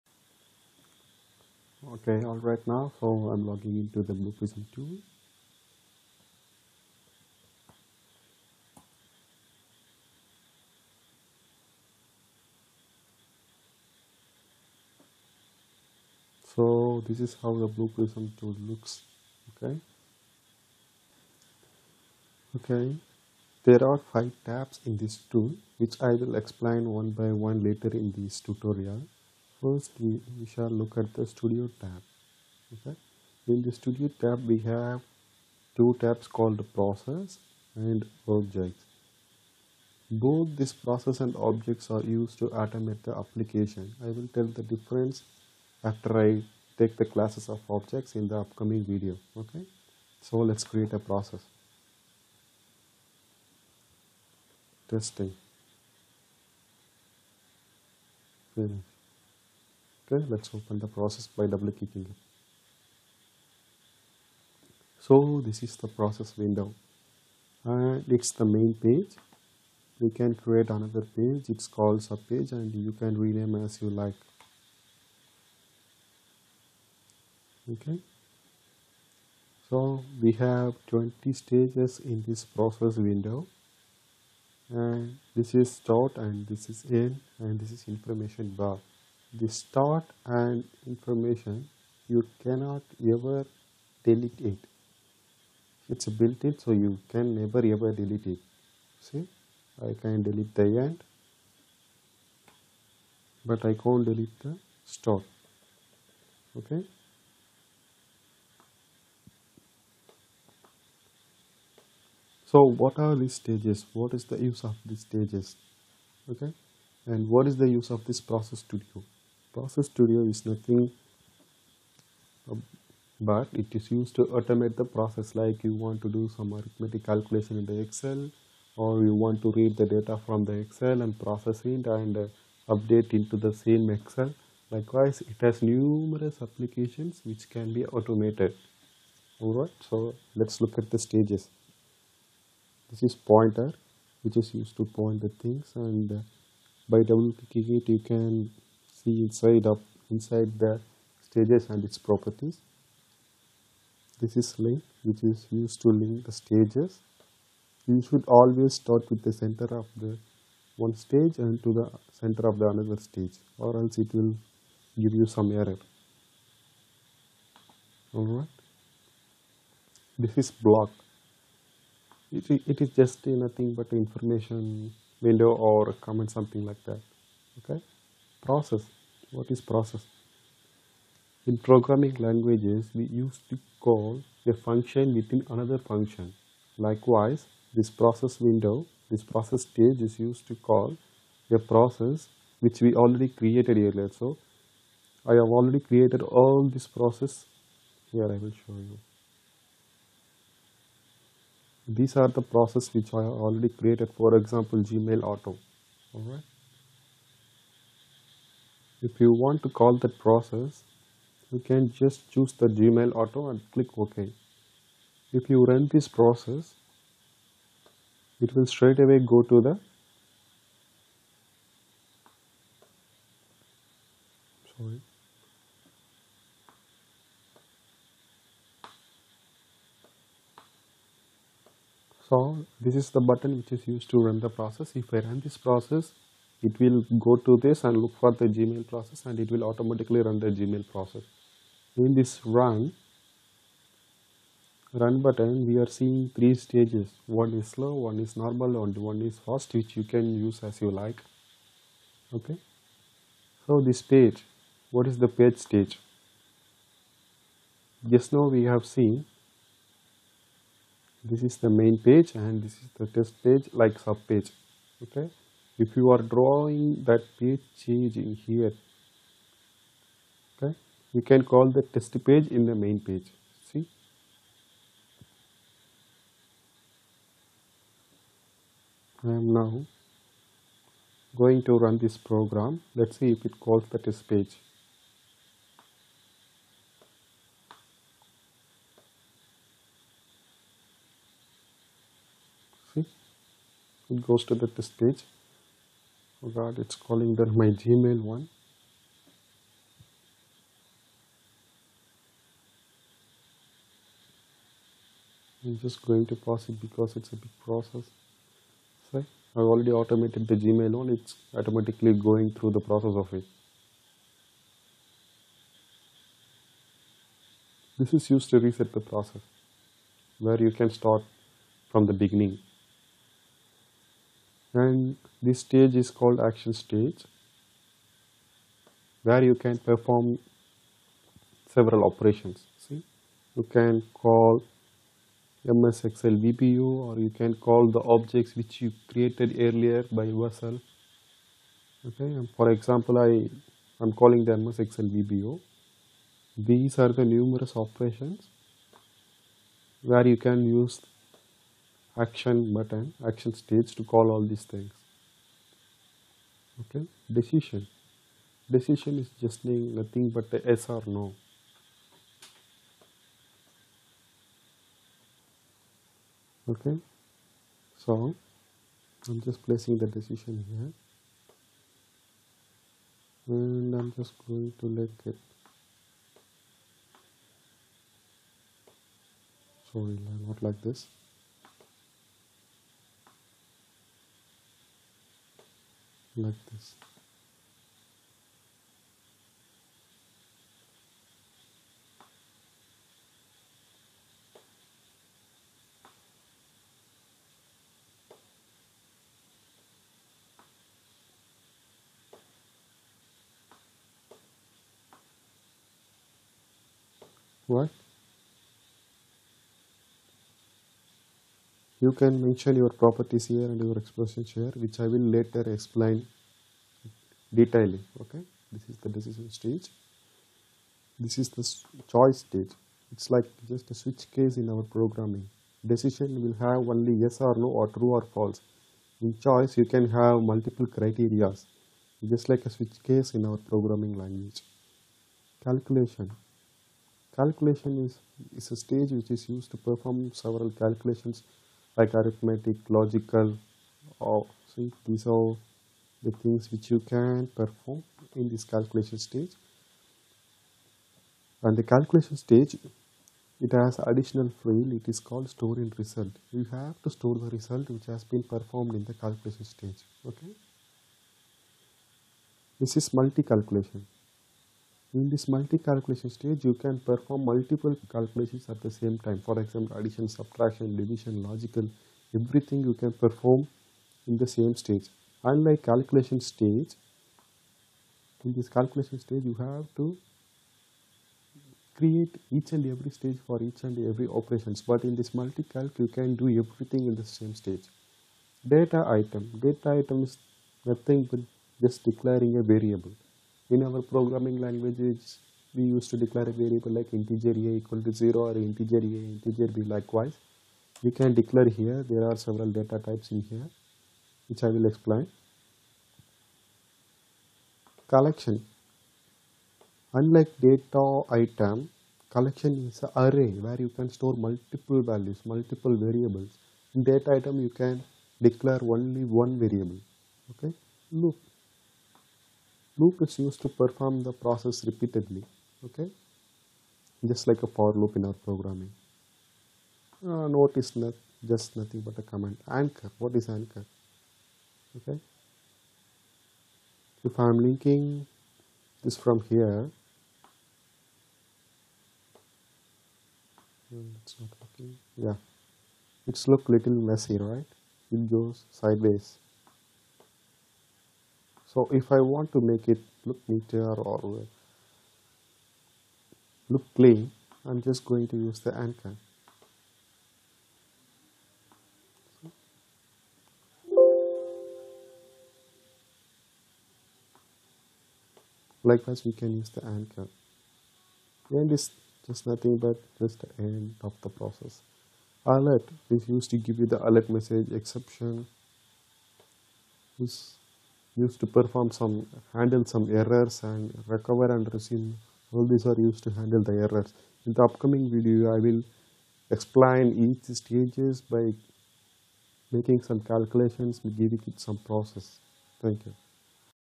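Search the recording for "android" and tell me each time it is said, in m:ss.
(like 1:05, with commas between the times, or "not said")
not said.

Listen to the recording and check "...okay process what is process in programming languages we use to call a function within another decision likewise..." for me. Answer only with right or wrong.
wrong.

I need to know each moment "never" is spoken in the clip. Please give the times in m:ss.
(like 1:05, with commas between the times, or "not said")
1:37.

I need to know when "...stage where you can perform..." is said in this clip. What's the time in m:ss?
5:26.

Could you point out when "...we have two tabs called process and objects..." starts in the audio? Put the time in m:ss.
0:34.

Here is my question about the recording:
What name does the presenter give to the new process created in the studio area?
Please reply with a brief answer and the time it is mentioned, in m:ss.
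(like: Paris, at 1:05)
testing, at 0:54.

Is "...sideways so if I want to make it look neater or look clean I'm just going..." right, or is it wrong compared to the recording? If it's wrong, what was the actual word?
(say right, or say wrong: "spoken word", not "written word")
right.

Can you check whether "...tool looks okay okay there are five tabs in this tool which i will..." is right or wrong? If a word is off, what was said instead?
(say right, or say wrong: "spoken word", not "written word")
right.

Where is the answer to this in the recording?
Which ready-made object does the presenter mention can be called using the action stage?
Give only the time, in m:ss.
5:35.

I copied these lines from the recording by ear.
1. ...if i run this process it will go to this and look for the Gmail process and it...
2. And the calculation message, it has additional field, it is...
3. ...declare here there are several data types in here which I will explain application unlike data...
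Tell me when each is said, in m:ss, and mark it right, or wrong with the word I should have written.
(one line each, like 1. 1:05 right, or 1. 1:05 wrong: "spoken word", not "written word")
1. 3:55 right
2. 7:31 wrong: "stage", not "message"
3. 8:21 wrong: "collection", not "application".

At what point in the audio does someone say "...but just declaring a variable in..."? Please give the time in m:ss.
8:11.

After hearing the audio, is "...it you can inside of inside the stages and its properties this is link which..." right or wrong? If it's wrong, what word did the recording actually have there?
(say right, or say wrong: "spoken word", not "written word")
right.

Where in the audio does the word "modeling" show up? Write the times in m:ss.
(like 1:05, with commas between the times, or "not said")
not said.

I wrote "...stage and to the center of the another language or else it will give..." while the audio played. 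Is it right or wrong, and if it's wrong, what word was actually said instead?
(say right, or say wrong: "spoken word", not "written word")
wrong: "stage", not "language".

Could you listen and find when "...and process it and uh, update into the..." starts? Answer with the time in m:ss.
2:11.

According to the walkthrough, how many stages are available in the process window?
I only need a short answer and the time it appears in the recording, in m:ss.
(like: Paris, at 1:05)
20, at 1:20.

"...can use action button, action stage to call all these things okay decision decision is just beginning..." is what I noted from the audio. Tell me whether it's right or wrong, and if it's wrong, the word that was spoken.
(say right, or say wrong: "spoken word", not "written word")
wrong: "nothing", not "beginning".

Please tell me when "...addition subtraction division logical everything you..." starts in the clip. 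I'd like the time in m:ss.
7:49.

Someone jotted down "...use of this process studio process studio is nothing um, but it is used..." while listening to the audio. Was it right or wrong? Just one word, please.
right.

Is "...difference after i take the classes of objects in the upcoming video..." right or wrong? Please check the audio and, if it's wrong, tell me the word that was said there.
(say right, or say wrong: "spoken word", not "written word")
right.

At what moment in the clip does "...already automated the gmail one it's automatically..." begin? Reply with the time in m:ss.
5:09.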